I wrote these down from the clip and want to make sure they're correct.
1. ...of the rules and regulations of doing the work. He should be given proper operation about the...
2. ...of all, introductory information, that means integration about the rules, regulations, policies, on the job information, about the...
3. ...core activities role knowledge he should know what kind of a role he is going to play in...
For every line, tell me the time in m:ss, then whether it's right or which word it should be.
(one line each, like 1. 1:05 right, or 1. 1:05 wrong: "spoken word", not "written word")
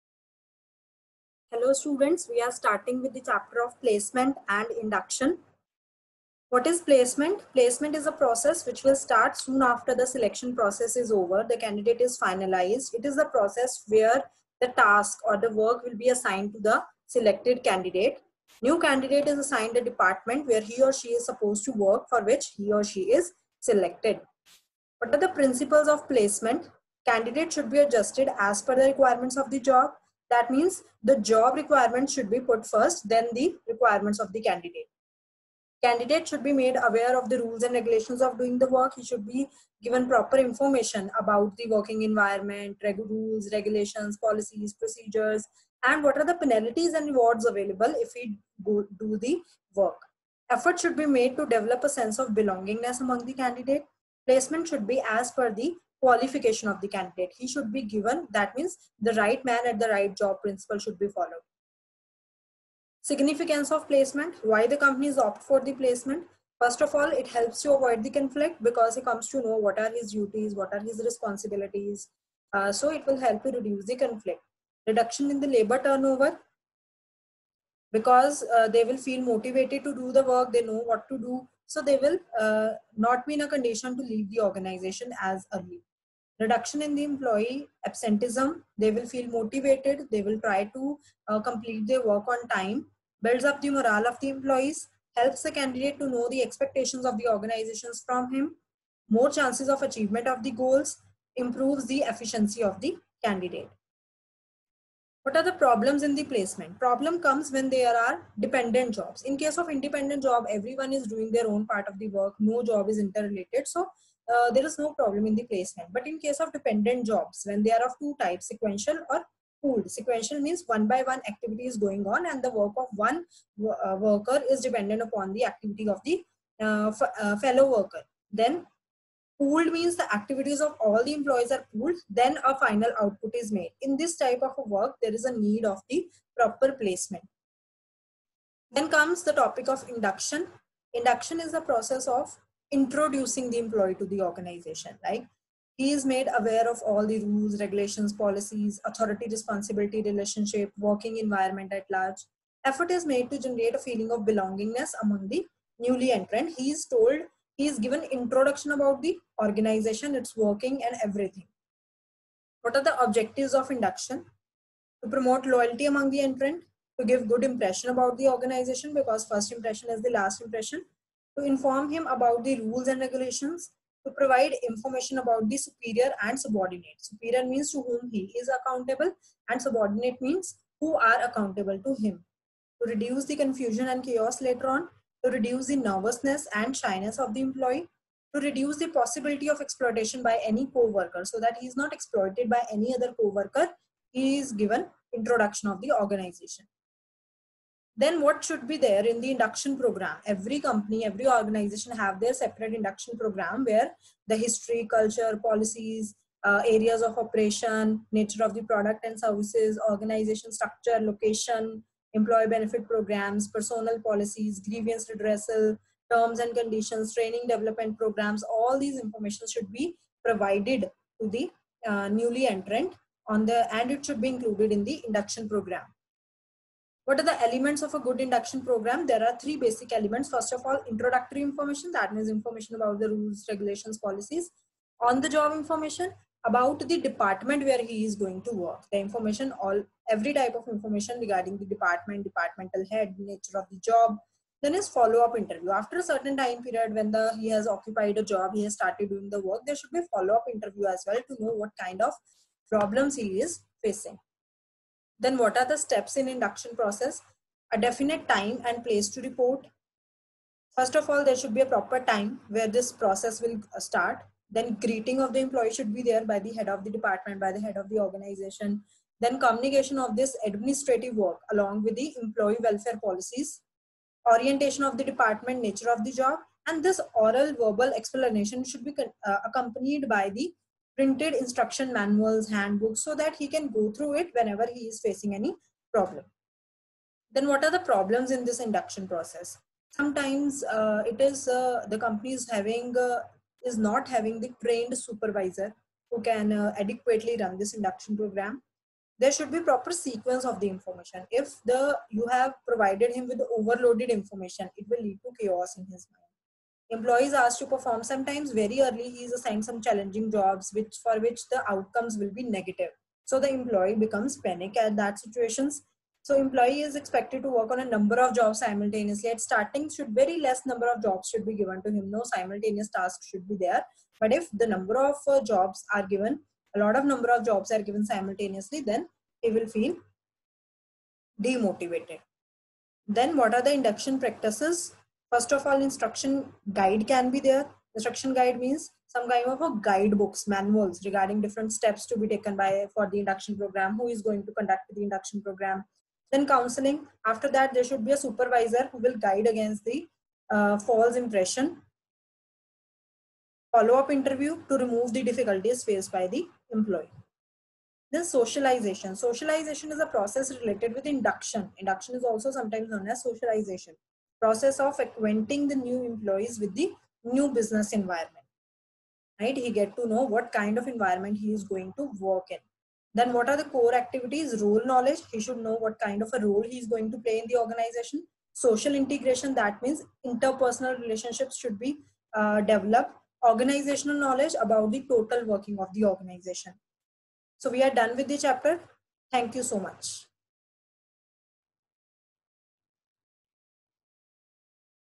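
1. 0:37 wrong: "information", not "operation"
2. 3:50 wrong: "information", not "integration"
3. 6:13 right.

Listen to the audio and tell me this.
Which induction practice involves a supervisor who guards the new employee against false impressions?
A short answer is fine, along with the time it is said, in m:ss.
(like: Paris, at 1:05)
Counseling, at 5:46.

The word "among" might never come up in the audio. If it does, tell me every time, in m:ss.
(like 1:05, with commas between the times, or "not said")
0:53, 2:35, 2:45.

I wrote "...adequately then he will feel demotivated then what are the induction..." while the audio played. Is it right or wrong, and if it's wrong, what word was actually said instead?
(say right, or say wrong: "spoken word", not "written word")
wrong: "simultaneously", not "adequately".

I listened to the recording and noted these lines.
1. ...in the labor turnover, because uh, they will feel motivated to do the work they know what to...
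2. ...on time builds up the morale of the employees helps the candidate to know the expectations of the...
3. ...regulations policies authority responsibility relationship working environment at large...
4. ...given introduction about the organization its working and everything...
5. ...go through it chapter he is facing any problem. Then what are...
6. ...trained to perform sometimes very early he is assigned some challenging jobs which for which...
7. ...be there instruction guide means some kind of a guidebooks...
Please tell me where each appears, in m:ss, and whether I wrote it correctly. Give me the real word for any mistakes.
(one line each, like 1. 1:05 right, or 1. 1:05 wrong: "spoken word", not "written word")
1. 1:15 right
2. 1:32 right
3. 2:27 right
4. 2:37 right
5. 4:43 wrong: "whenever", not "chapter"
6. 5:07 wrong: "asked", not "trained"
7. 5:37 right.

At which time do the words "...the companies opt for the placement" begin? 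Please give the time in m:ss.
1:04.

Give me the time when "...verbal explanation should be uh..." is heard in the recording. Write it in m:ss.
4:37.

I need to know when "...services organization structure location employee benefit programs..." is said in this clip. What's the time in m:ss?
3:29.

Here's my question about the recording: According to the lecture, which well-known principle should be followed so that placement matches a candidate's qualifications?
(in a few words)
Right man at the right job.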